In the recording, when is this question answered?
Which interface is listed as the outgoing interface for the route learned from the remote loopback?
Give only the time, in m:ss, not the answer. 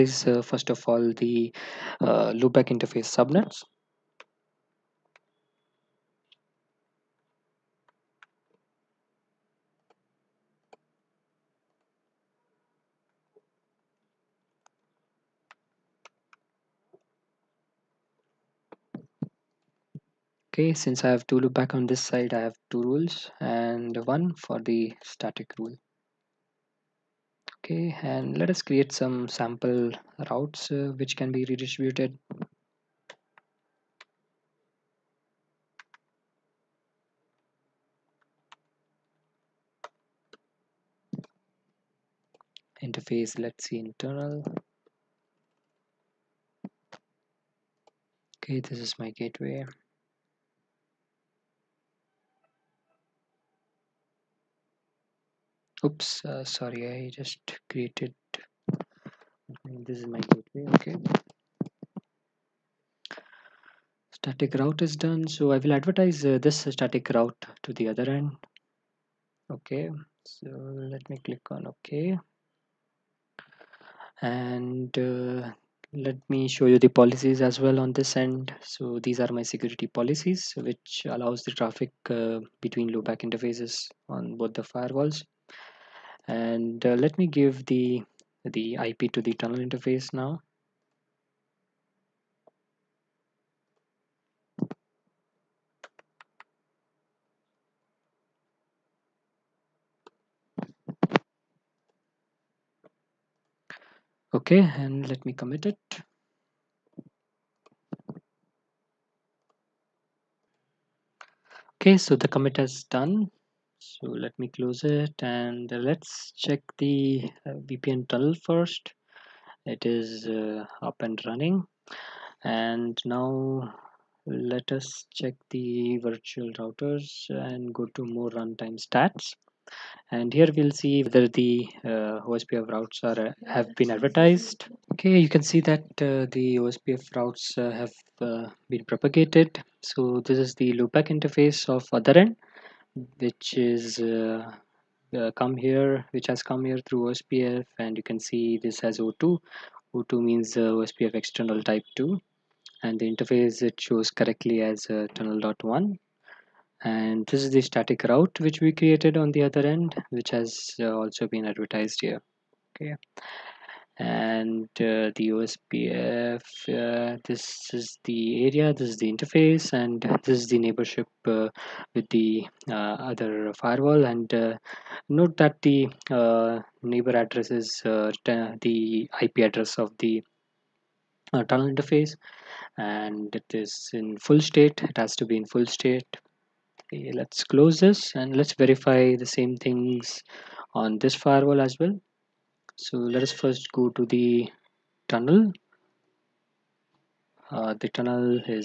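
2:35.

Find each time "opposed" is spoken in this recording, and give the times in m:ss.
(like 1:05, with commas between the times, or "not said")
not said.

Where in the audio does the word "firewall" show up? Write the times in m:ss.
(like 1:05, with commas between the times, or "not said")
1:24, 2:53, 3:11.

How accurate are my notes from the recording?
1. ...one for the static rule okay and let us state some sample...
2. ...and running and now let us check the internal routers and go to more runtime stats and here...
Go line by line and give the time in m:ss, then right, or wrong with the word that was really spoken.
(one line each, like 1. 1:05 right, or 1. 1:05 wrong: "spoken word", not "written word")
1. 0:24 wrong: "create", not "state"
2. 2:00 wrong: "virtual", not "internal".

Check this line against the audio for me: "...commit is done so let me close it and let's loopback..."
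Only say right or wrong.
wrong.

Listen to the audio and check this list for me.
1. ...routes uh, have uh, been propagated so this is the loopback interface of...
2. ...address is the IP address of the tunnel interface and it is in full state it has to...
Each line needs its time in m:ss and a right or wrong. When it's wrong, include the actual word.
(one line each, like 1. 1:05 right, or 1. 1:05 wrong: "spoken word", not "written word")
1. 2:17 right
2. 2:57 right.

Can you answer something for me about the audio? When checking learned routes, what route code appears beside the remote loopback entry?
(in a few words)
O2.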